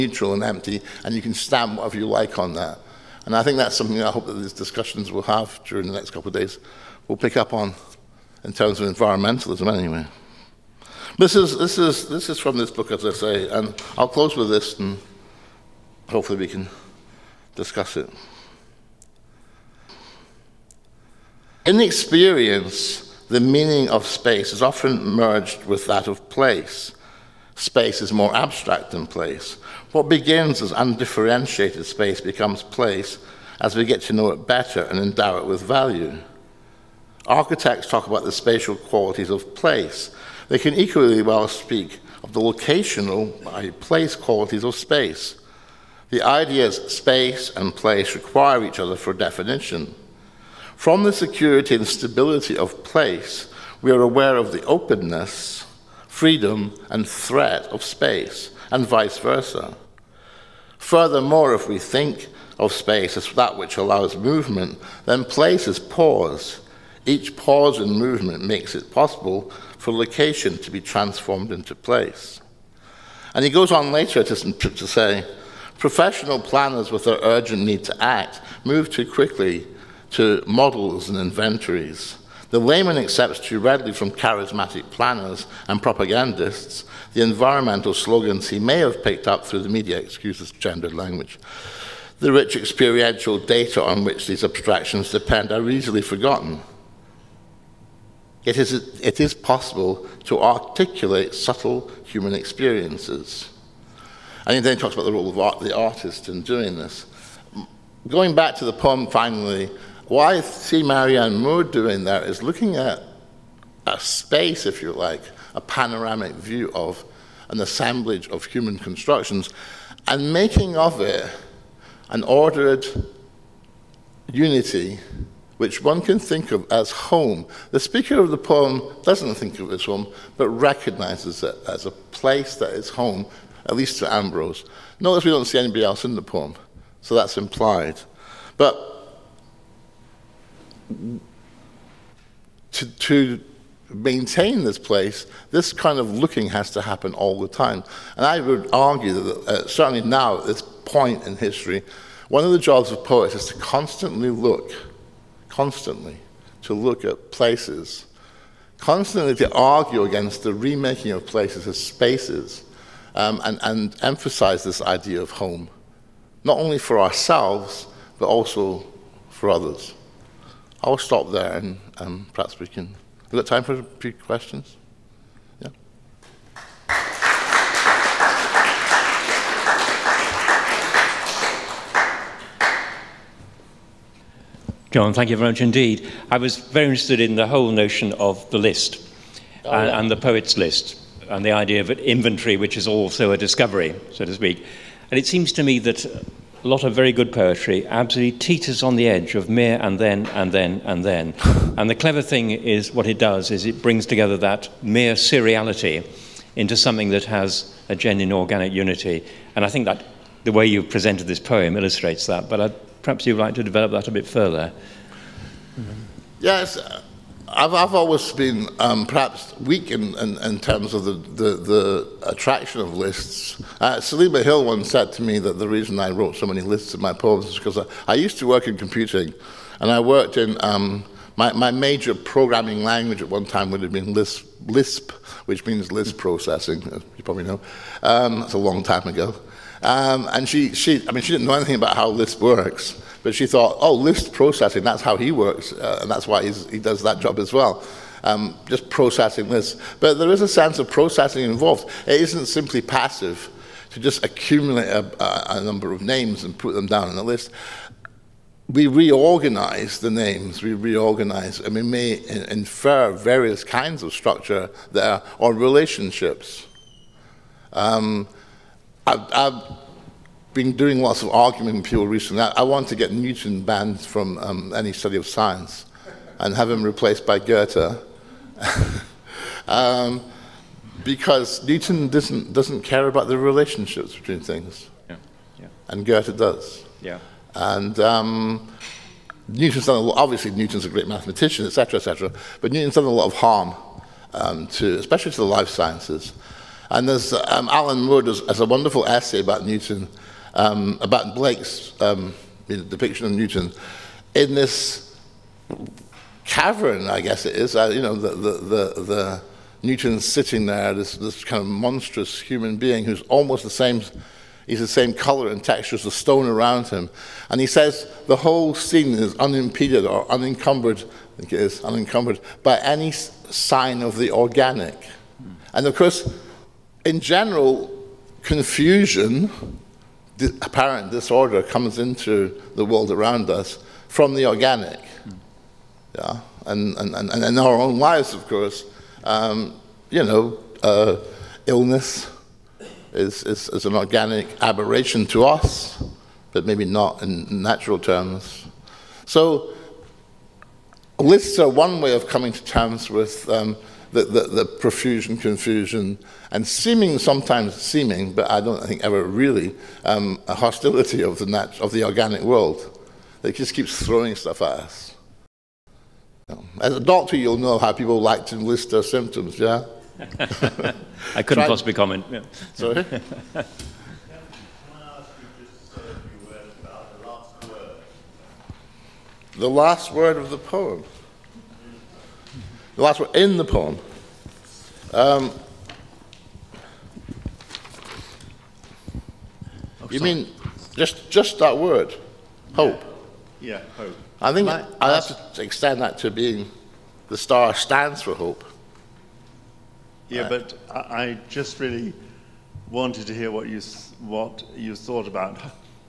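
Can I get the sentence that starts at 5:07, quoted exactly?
Uh, you know, the, the, the, the Newton's sitting there, this, this kind of monstrous human being who's almost the same.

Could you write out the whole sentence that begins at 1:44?
And then he talks about the role of art, the artist in doing this.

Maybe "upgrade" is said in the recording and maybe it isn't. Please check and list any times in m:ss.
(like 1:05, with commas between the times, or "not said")
not said.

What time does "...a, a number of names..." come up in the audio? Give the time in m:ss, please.
4:15.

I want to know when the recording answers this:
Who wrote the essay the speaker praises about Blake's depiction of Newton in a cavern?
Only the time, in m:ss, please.
4:57.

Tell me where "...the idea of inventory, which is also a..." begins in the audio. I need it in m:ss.
3:11.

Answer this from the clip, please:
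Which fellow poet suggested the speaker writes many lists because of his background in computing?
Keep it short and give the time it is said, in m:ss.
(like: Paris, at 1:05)
Selima Hill, at 3:44.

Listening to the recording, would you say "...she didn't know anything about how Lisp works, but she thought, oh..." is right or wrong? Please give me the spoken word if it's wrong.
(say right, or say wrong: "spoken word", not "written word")
right.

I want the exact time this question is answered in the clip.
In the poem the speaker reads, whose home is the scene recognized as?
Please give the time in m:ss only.
2:14.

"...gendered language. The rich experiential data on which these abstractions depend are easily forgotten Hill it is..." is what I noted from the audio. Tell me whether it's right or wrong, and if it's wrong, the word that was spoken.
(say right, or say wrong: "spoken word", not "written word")
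wrong: "Yet", not "Hill".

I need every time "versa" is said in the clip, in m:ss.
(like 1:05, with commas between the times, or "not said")
0:59.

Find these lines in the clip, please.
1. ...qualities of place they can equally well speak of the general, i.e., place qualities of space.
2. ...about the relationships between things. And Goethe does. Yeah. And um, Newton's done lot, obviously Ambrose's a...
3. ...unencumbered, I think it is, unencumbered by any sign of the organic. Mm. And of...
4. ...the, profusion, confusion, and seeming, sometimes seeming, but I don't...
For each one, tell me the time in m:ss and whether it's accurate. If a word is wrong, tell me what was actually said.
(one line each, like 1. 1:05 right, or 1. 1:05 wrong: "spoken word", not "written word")
1. 0:38 wrong: "locational", not "general"
2. 4:43 wrong: "Newton", not "Ambrose"
3. 5:20 right
4. 5:54 right.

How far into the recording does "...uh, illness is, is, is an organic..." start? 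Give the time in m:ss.
5:40.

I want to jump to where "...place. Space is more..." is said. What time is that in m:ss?
0:26.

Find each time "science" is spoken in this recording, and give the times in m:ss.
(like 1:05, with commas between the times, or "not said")
4:35, 4:55.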